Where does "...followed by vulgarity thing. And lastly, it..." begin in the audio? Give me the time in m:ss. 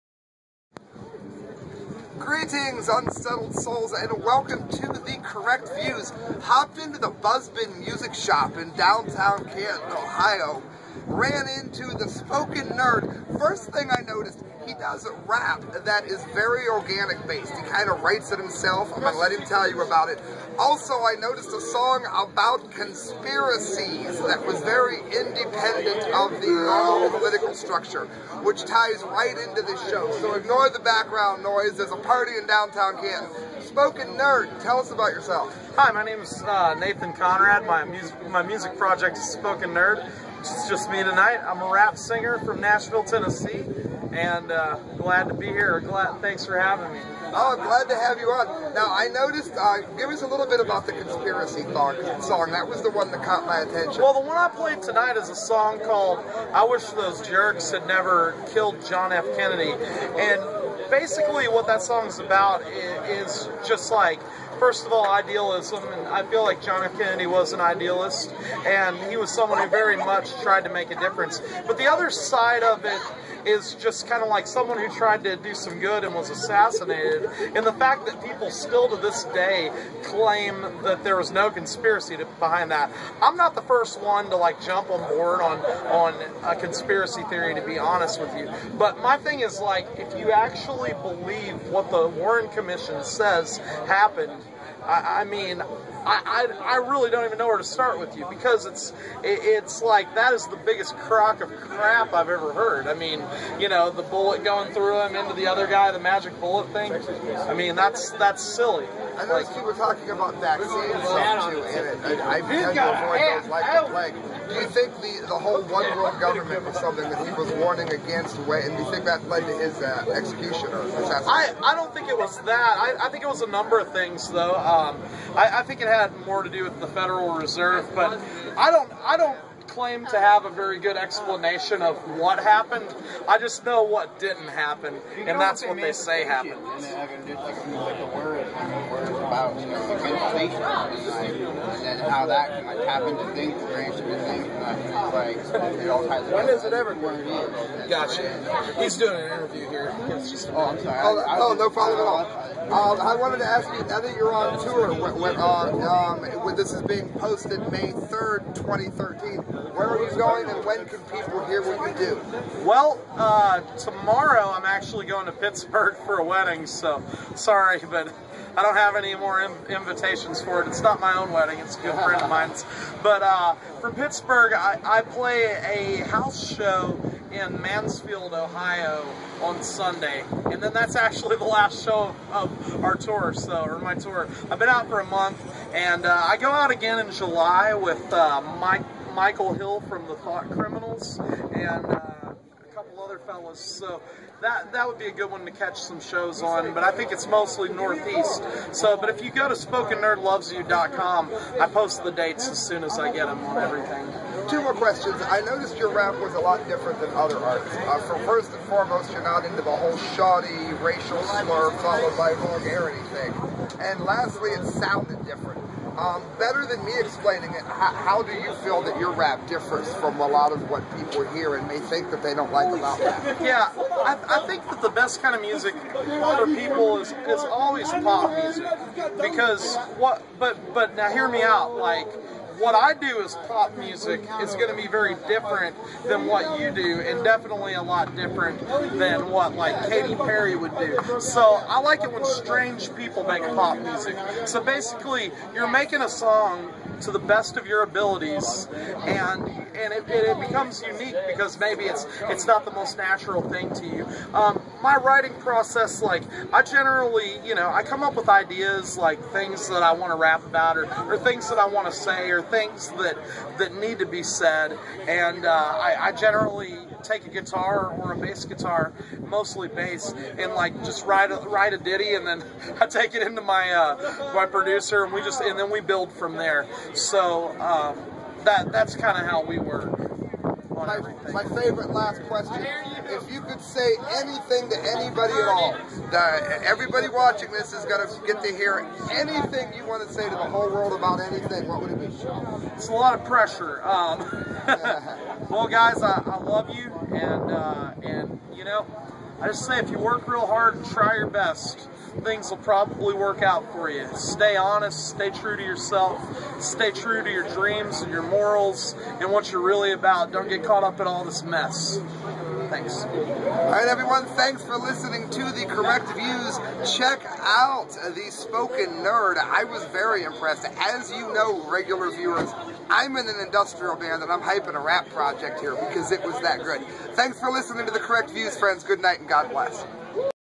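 3:31.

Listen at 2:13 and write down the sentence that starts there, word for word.
I just know what didn't happen, and that's what they say happened.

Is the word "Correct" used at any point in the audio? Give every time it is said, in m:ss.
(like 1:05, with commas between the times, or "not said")
0:05, 5:15, 5:27.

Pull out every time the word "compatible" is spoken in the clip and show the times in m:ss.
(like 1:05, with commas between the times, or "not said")
not said.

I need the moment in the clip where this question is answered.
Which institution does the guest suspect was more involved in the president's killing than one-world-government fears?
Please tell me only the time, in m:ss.
2:06.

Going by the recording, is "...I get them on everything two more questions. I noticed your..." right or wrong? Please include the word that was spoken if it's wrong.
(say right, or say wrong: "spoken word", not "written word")
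right.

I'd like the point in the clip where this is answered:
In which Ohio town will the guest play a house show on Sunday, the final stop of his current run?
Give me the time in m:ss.
2:57.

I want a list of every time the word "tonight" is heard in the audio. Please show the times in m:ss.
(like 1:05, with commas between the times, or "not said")
0:41, 0:54.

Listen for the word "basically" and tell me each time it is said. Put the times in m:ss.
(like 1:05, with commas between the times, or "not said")
1:00, 4:04.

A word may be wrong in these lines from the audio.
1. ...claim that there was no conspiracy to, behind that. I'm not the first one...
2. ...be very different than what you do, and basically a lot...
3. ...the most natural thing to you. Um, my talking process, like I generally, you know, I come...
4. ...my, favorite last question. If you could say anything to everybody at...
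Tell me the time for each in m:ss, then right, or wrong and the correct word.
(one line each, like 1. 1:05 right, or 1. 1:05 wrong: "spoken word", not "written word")
1. 1:20 right
2. 3:54 wrong: "definitely", not "basically"
3. 4:12 wrong: "writing", not "talking"
4. 4:41 wrong: "anybody", not "everybody".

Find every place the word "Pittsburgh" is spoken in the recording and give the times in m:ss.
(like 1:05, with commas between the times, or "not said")
2:45, 2:53.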